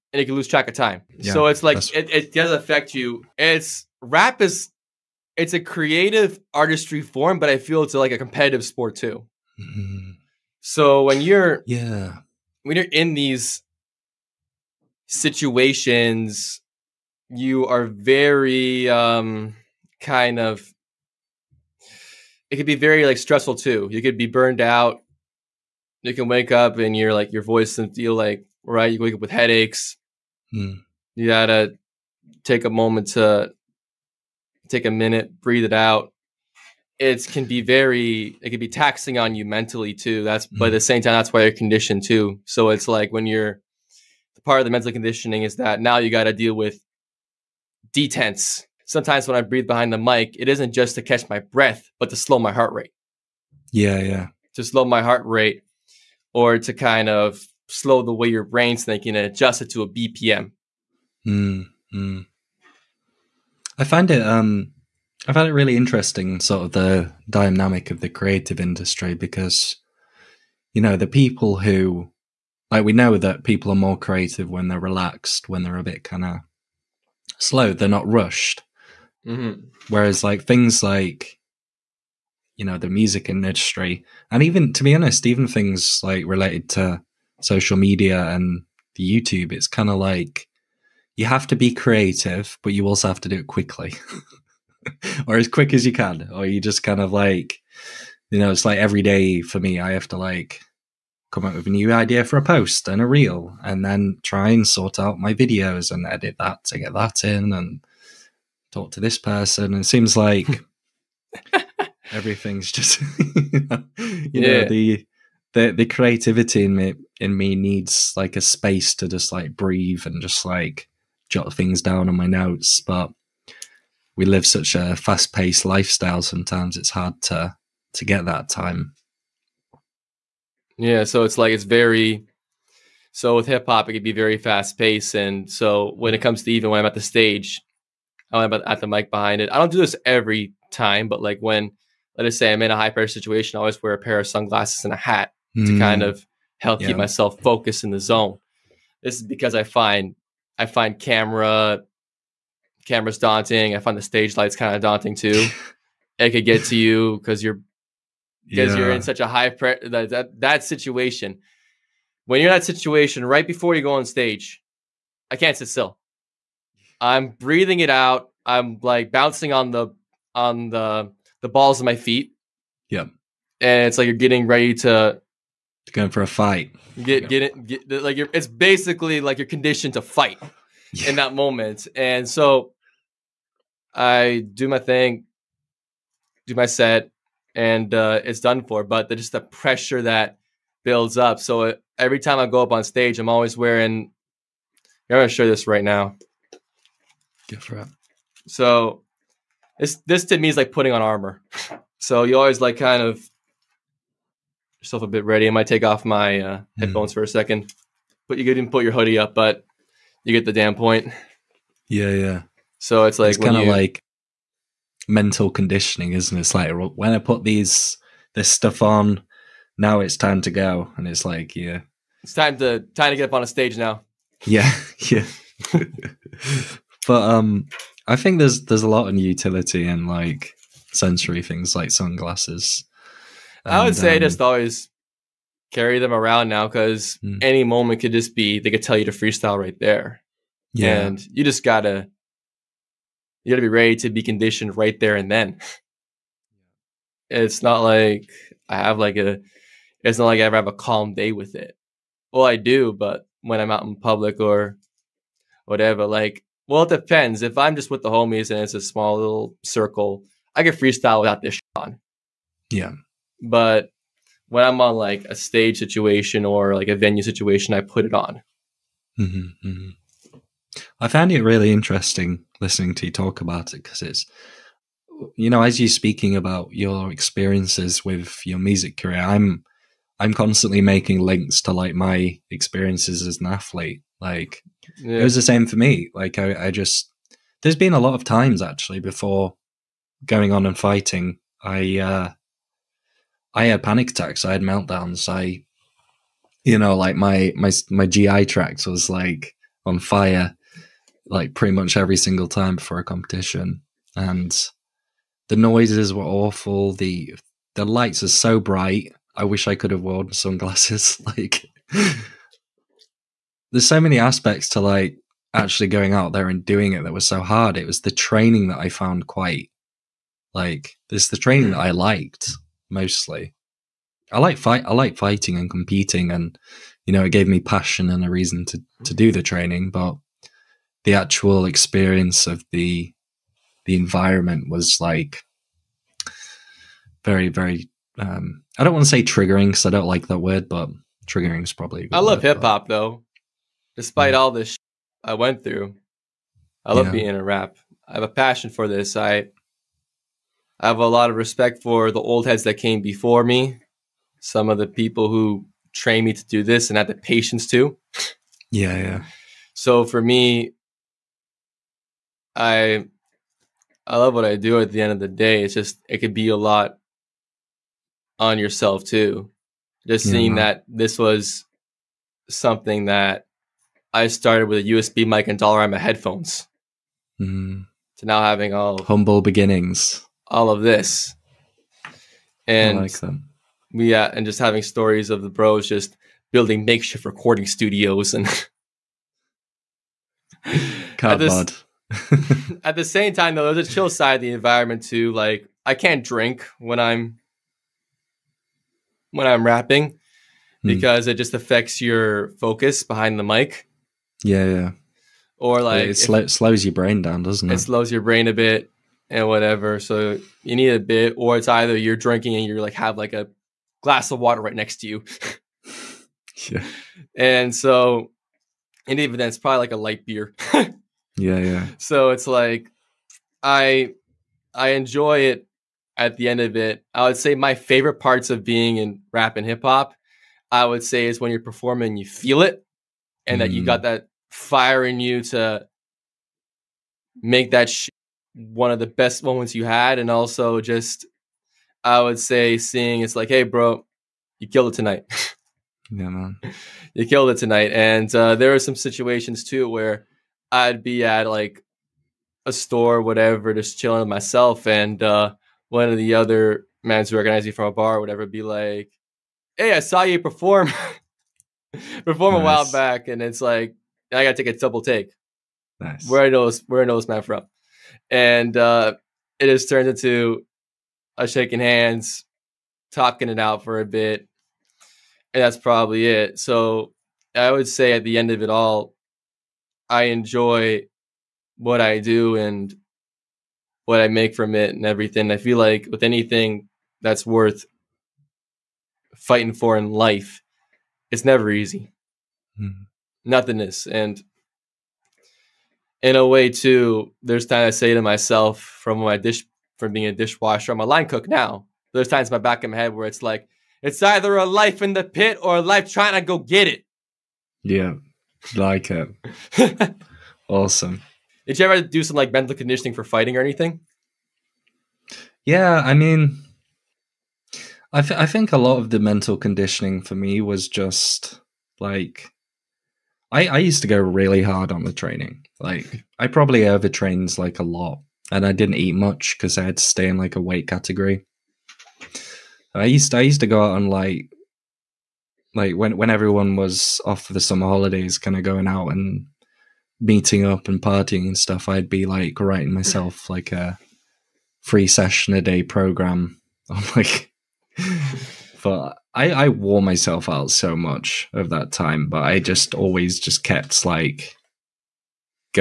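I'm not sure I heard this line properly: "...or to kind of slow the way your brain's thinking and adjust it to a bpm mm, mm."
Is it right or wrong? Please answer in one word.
right.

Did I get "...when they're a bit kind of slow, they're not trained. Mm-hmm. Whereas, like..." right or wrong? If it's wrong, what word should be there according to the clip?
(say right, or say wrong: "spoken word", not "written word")
wrong: "rushed", not "trained".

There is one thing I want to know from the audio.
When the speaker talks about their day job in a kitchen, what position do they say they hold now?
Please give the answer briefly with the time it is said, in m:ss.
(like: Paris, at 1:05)
line cook, at 8:21.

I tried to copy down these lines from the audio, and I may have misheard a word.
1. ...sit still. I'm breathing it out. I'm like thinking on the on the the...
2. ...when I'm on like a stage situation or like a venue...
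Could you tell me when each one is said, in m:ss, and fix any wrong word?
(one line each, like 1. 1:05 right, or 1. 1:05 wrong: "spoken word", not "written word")
1. 2:45 wrong: "bouncing", not "thinking"
2. 4:24 right.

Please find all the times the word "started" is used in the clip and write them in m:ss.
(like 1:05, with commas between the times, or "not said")
6:14.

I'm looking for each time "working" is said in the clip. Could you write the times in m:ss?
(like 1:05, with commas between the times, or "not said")
not said.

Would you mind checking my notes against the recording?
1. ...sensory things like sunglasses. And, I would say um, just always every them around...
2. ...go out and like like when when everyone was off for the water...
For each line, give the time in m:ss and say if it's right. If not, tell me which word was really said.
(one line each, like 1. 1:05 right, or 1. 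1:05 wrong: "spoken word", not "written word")
1. 3:50 wrong: "carry", not "every"
2. 8:53 wrong: "summer", not "water".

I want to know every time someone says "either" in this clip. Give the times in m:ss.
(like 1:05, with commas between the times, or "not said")
6:51, 8:24.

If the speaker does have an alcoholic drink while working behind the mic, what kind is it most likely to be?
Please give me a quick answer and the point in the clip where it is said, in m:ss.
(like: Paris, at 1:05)
light beer, at 6:59.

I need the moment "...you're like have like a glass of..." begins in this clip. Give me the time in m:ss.
6:52.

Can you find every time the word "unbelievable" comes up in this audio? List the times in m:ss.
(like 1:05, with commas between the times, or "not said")
not said.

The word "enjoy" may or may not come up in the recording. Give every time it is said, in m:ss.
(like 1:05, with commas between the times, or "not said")
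7:04, 8:00.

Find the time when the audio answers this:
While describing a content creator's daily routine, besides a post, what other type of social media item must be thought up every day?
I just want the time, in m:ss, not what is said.
1:43.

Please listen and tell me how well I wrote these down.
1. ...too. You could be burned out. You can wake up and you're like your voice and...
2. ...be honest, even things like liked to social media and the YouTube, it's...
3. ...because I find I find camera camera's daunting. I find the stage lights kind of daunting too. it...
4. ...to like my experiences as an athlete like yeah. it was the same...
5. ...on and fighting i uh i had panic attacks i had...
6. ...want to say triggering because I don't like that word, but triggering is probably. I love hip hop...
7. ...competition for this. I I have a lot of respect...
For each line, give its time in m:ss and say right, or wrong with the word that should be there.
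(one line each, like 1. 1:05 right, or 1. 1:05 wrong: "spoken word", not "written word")
1. 0:23 right
2. 1:24 wrong: "related", not "liked"
3. 2:29 right
4. 4:41 right
5. 4:50 right
6. 5:38 right
7. 5:48 wrong: "passion", not "competition".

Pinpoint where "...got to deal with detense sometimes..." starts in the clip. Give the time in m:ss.
0:46.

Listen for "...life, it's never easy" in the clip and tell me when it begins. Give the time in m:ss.
8:10.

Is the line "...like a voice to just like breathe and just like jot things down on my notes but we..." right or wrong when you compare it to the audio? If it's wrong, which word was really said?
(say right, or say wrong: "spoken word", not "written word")
wrong: "space", not "voice".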